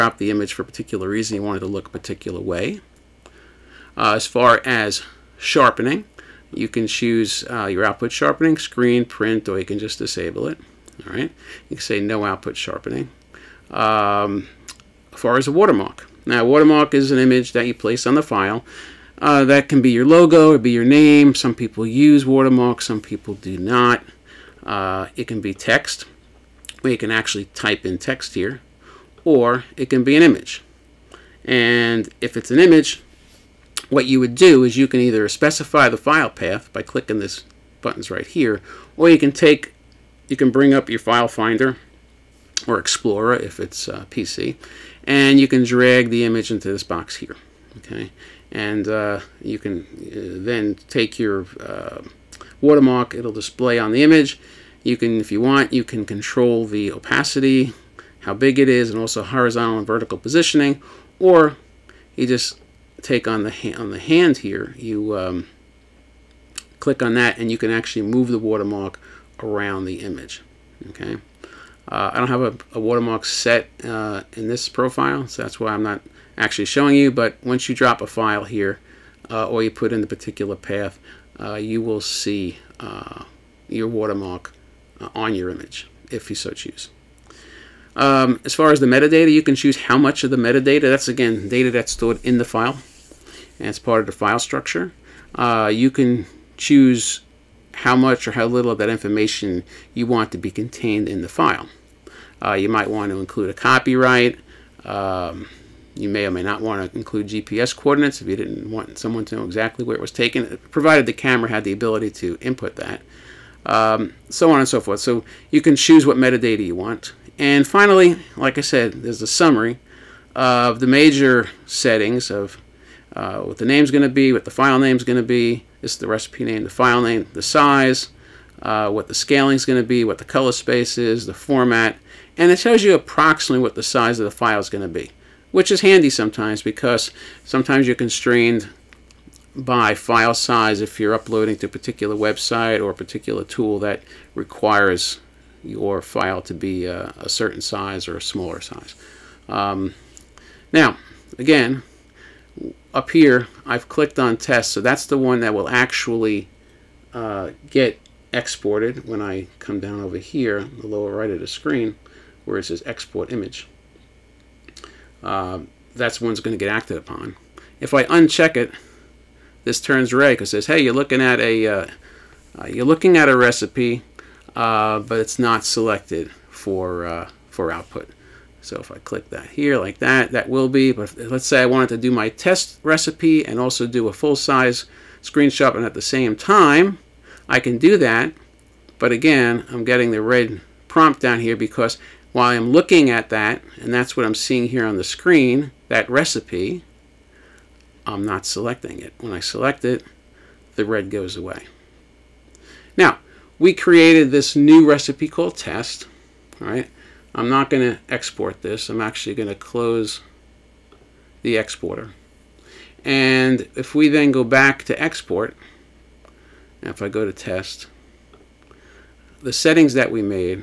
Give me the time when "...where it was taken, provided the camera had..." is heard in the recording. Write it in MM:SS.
01:49.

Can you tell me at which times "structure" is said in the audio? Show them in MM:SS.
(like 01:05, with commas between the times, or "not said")
01:34.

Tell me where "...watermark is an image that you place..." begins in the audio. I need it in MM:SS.
00:16.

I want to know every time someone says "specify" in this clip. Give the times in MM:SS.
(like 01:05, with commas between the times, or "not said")
00:35.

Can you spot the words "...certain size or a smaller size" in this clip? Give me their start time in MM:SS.
02:27.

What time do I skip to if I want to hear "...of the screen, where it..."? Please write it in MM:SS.
02:41.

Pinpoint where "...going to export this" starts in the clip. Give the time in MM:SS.
03:27.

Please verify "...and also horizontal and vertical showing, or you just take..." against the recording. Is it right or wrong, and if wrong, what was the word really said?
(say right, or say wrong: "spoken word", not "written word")
wrong: "positioning", not "showing".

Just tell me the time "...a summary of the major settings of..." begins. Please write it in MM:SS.
01:59.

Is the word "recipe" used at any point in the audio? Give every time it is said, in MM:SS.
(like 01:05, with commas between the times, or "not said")
02:06, 02:53, 03:02, 03:16, 03:24.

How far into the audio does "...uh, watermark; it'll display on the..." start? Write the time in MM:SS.
00:51.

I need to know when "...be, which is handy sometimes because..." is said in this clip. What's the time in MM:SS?
02:14.